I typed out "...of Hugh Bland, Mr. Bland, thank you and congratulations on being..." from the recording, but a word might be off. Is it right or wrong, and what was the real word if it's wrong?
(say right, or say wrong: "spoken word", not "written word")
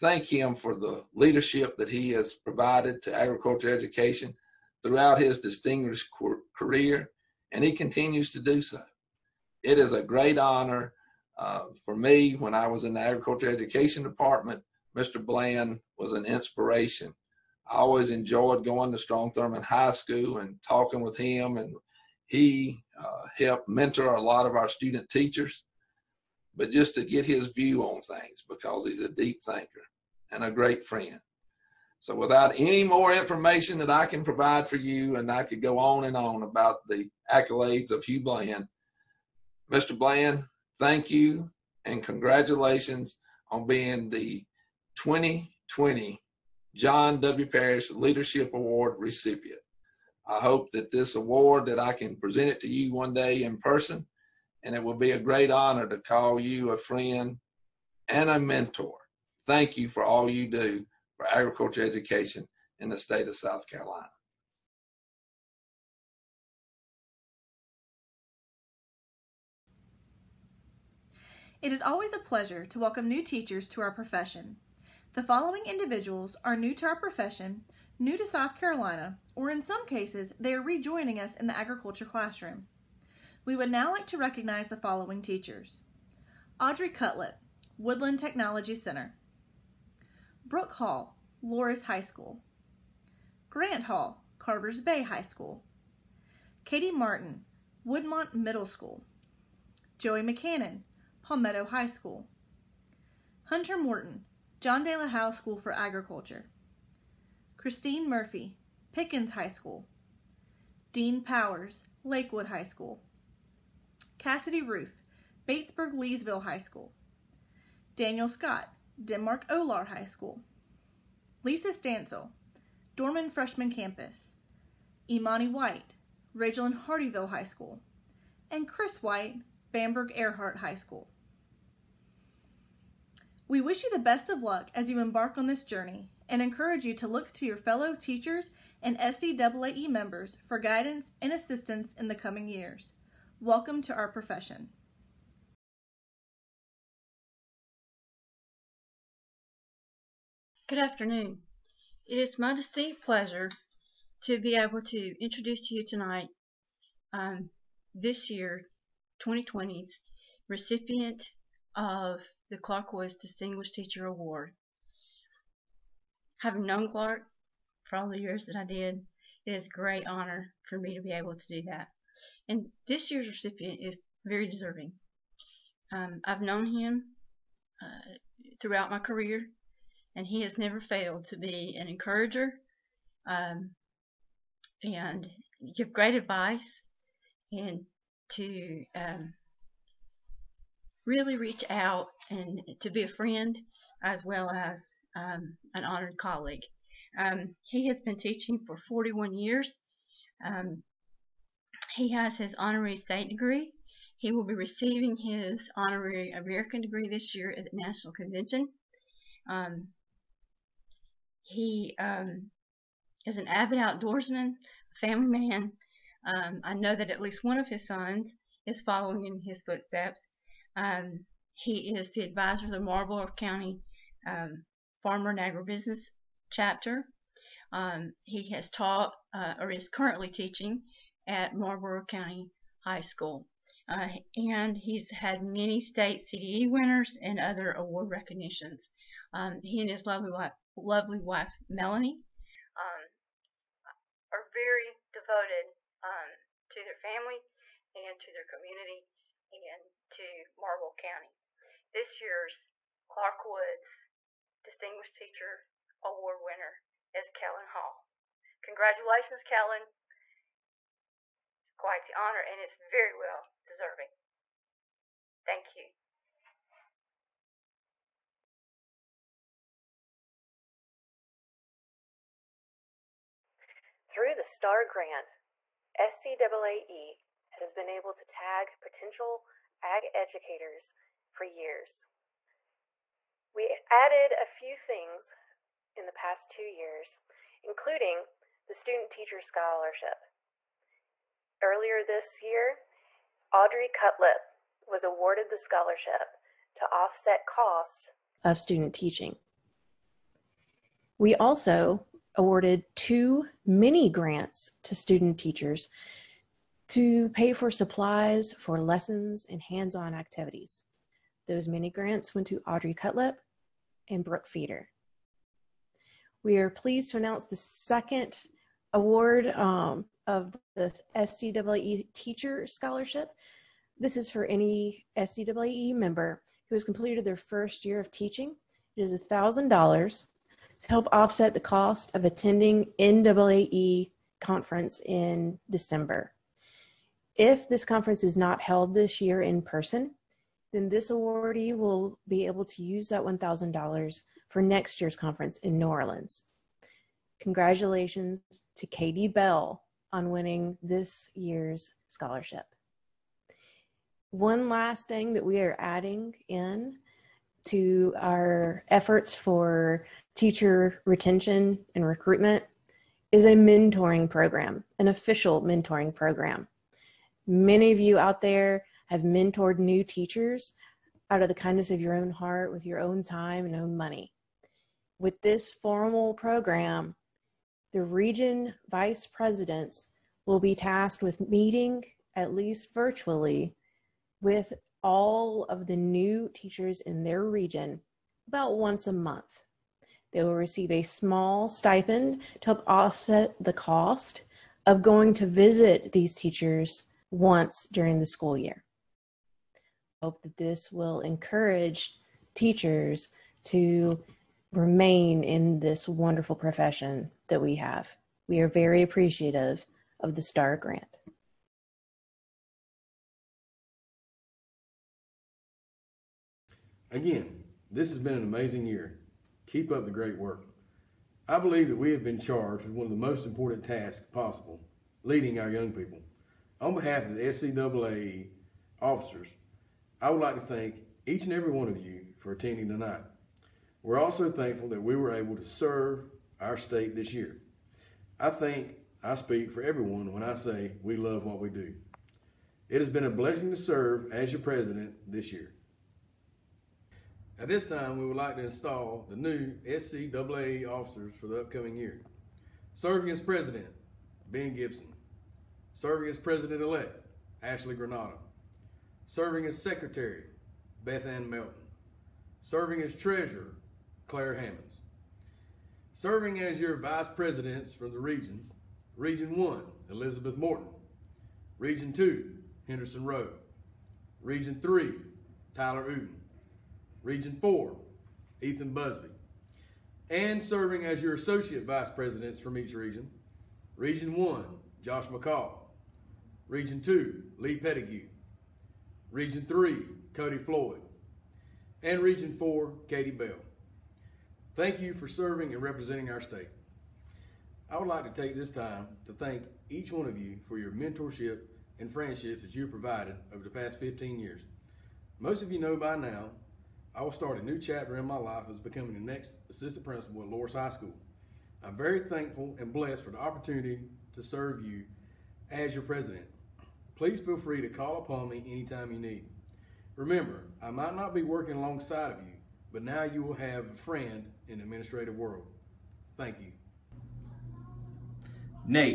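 right.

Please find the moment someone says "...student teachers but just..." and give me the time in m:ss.
0:24.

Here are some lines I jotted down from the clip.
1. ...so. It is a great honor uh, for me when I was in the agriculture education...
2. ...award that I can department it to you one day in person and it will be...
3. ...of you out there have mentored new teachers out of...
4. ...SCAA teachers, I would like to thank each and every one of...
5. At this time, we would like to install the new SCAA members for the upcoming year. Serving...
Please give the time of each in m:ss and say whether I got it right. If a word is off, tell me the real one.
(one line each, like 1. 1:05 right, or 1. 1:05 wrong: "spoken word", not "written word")
1. 0:08 right
2. 0:51 wrong: "present", not "department"
3. 6:07 right
4. 7:07 wrong: "officers", not "teachers"
5. 7:27 wrong: "officers", not "members".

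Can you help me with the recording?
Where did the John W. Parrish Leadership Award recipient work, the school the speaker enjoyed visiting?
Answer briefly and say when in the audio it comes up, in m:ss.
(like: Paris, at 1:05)
Strom Thurmond High School, at 0:18.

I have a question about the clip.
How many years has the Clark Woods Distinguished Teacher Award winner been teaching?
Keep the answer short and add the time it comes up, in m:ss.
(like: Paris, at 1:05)
41, at 3:18.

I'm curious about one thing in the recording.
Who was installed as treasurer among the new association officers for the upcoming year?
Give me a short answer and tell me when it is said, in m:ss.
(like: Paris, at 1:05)
Clair Hammonds, at 7:44.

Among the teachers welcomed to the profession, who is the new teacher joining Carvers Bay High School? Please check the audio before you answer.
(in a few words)
Grant Hall.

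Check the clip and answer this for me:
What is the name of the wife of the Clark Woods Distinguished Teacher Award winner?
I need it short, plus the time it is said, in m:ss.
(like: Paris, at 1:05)
Melanie, at 4:01.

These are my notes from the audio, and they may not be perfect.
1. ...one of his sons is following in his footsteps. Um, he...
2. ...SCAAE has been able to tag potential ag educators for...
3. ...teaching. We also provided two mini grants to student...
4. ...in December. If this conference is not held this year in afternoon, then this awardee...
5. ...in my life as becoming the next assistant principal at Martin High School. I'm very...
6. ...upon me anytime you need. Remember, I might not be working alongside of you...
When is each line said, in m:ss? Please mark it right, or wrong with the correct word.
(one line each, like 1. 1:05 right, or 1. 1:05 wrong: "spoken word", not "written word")
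1. 3:37 right
2. 4:35 right
3. 4:58 wrong: "awarded", not "provided"
4. 5:35 wrong: "person", not "afternoon"
5. 8:28 wrong: "Loris", not "Martin"
6. 8:38 right.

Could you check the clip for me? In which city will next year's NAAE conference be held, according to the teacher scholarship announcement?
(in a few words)
New Orleans.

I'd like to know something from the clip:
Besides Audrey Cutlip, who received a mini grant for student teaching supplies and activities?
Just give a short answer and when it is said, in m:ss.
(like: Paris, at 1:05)
Brooke Feeder, at 5:14.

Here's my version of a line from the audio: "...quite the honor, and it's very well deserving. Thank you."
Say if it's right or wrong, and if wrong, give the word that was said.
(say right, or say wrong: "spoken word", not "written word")
right.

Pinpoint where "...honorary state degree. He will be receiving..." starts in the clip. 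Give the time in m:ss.
3:22.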